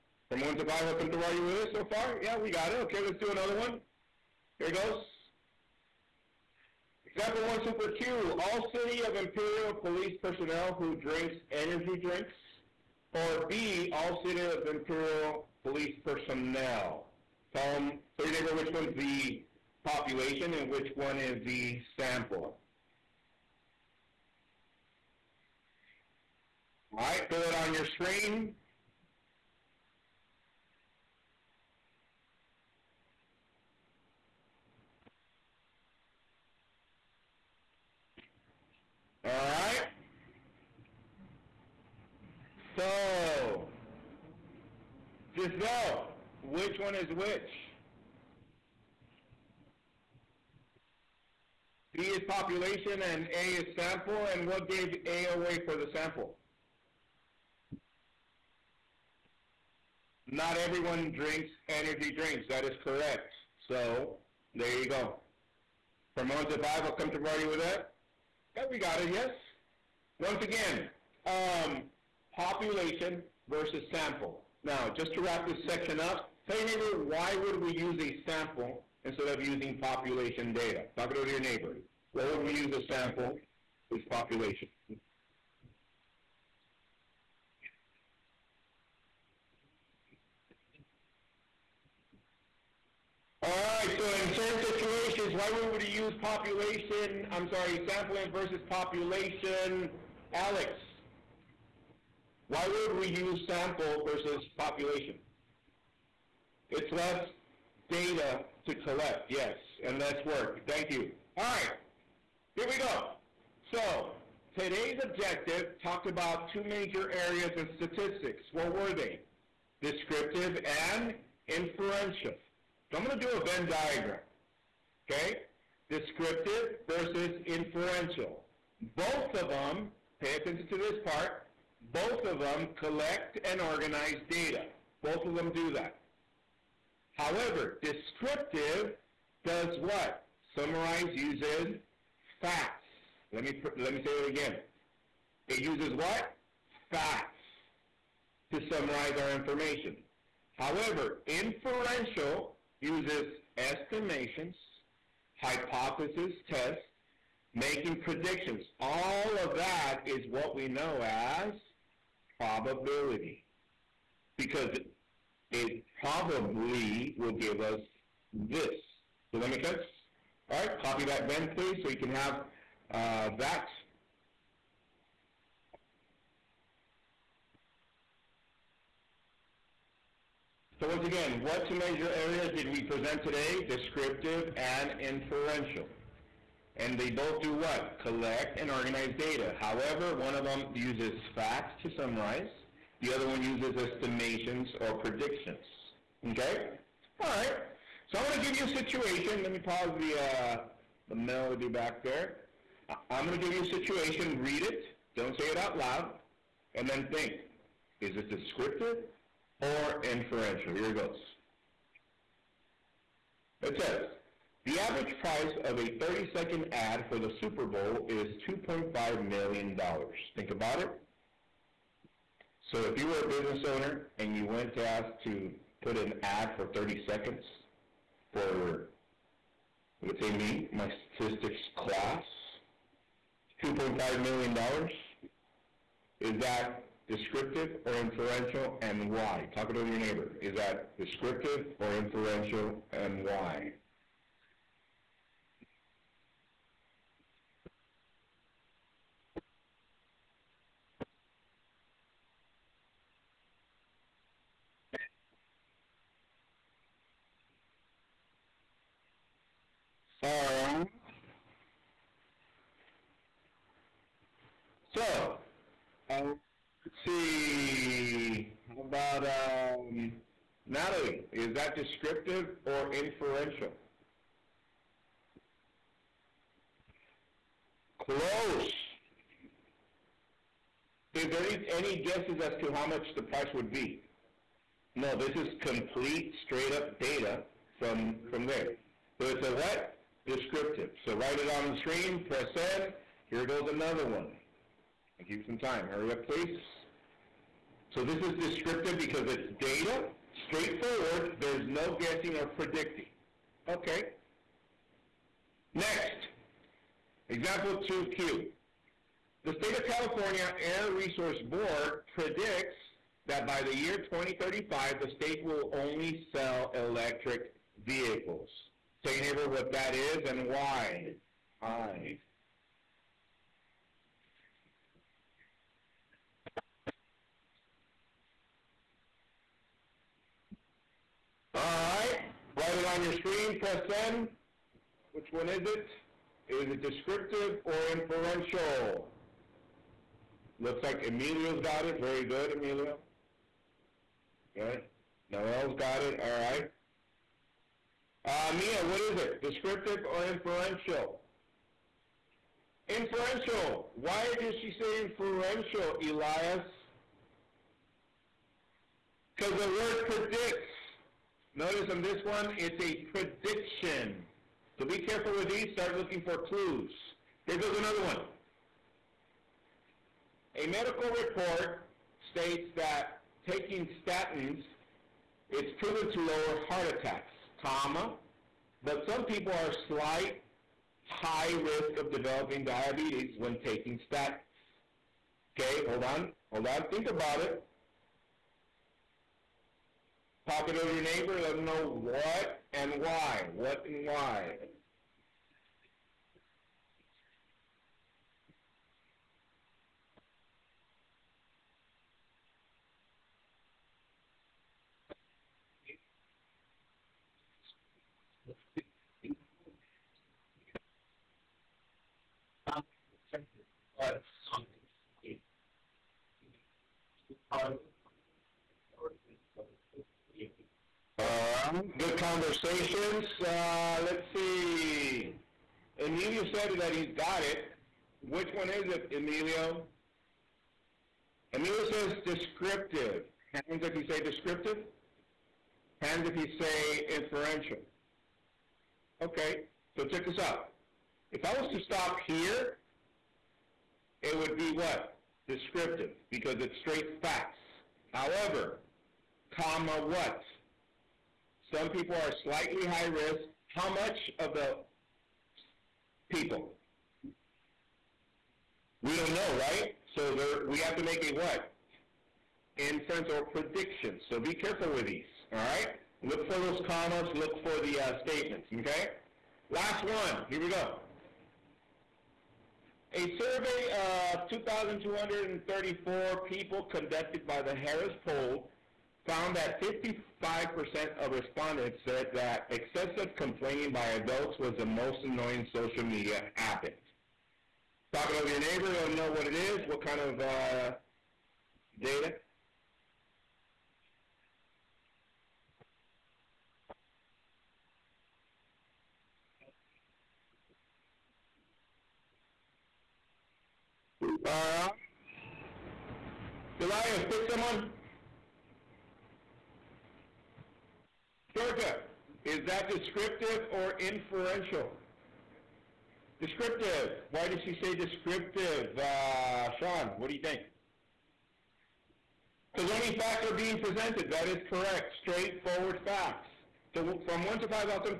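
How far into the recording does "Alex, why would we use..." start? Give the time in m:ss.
1:40.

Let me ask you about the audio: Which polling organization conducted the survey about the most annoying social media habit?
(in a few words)
Harris Poll.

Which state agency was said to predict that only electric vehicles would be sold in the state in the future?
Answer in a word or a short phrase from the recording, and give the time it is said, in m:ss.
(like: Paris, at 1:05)
California Air Resource Board, at 5:09.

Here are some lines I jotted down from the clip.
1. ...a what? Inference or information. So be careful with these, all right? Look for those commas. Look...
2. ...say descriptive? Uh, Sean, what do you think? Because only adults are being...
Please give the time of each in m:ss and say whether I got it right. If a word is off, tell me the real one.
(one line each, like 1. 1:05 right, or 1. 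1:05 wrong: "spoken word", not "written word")
1. 7:41 wrong: "prediction", not "information"
2. 8:37 wrong: "facts", not "adults".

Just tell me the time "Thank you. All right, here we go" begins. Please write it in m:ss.
1:50.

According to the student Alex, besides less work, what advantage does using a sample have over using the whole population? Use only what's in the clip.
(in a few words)
Less data to collect.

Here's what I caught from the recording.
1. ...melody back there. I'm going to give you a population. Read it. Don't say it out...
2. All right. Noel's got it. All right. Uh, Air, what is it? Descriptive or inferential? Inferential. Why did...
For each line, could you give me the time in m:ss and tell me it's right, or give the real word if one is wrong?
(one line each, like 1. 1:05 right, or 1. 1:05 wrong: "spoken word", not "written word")
1. 3:21 wrong: "situation", not "population"
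2. 5:44 wrong: "Mia", not "Air".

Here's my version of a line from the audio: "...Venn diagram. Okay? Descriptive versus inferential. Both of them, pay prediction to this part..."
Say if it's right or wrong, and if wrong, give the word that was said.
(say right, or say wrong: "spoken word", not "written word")
wrong: "attention", not "prediction".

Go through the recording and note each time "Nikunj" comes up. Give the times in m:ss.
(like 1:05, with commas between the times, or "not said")
not said.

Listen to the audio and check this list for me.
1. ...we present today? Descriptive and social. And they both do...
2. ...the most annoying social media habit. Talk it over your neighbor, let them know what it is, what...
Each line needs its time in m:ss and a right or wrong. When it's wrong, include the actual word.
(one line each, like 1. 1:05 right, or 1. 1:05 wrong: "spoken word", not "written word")
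1. 3:02 wrong: "inferential", not "social"
2. 8:04 right.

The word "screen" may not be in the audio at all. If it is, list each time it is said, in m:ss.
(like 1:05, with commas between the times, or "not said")
0:27, 4:51, 5:33.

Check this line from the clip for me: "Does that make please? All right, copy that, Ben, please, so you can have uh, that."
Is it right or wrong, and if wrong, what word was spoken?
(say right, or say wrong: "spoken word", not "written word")
wrong: "sense", not "please".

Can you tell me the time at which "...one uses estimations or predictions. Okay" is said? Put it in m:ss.
3:13.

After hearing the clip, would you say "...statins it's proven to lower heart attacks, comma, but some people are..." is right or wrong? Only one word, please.
right.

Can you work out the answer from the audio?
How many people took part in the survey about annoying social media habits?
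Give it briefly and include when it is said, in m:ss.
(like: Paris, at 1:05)
2,234, at 7:54.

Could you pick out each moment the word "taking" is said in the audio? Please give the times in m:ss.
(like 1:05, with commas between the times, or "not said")
6:13, 6:23.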